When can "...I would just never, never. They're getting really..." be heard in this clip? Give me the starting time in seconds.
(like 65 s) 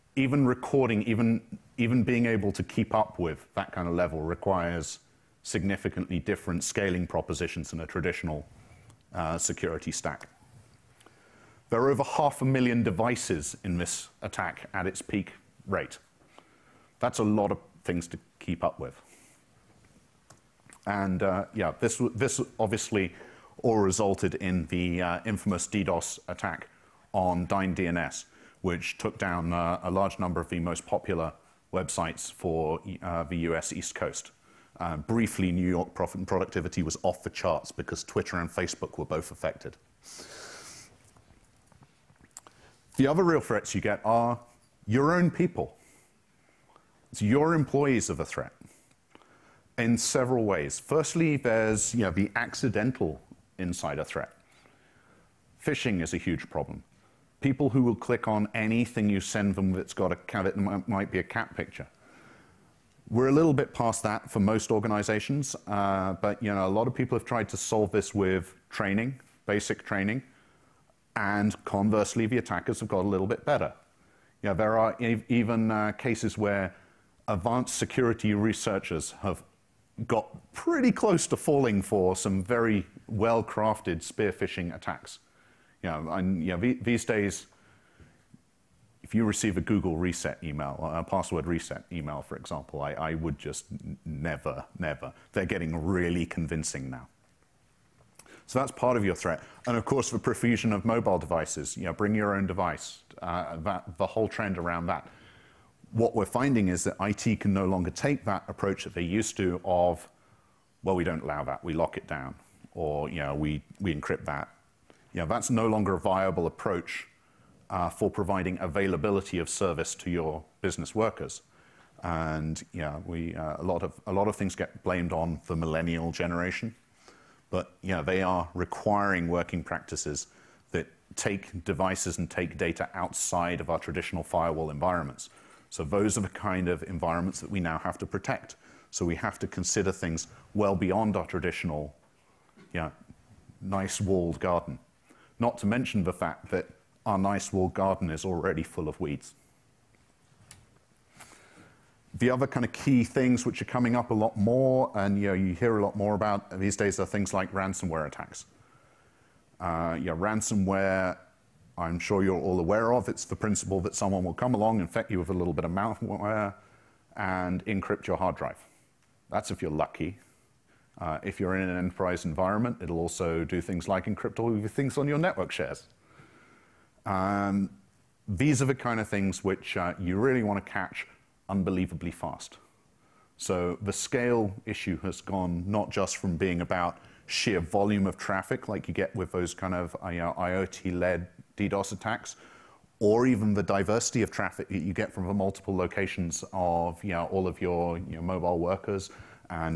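92 s.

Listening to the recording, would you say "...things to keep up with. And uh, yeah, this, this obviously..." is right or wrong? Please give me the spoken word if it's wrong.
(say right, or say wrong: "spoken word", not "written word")
right.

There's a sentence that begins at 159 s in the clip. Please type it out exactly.
Uh, yeah, ransomware, I'm sure you're all aware of.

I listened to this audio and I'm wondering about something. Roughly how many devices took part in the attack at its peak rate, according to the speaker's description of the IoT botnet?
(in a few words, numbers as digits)
over half a million.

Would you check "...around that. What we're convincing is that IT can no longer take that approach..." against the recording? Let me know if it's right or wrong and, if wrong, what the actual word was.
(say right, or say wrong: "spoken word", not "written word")
wrong: "finding", not "convincing".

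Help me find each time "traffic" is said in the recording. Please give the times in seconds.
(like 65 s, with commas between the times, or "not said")
188 s, 194 s.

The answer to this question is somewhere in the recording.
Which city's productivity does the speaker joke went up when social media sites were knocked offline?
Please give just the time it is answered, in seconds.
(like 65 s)
35 s.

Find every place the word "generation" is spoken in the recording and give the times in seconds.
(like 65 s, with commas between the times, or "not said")
126 s.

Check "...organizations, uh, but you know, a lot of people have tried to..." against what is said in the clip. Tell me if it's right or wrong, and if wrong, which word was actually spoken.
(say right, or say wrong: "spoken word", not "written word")
right.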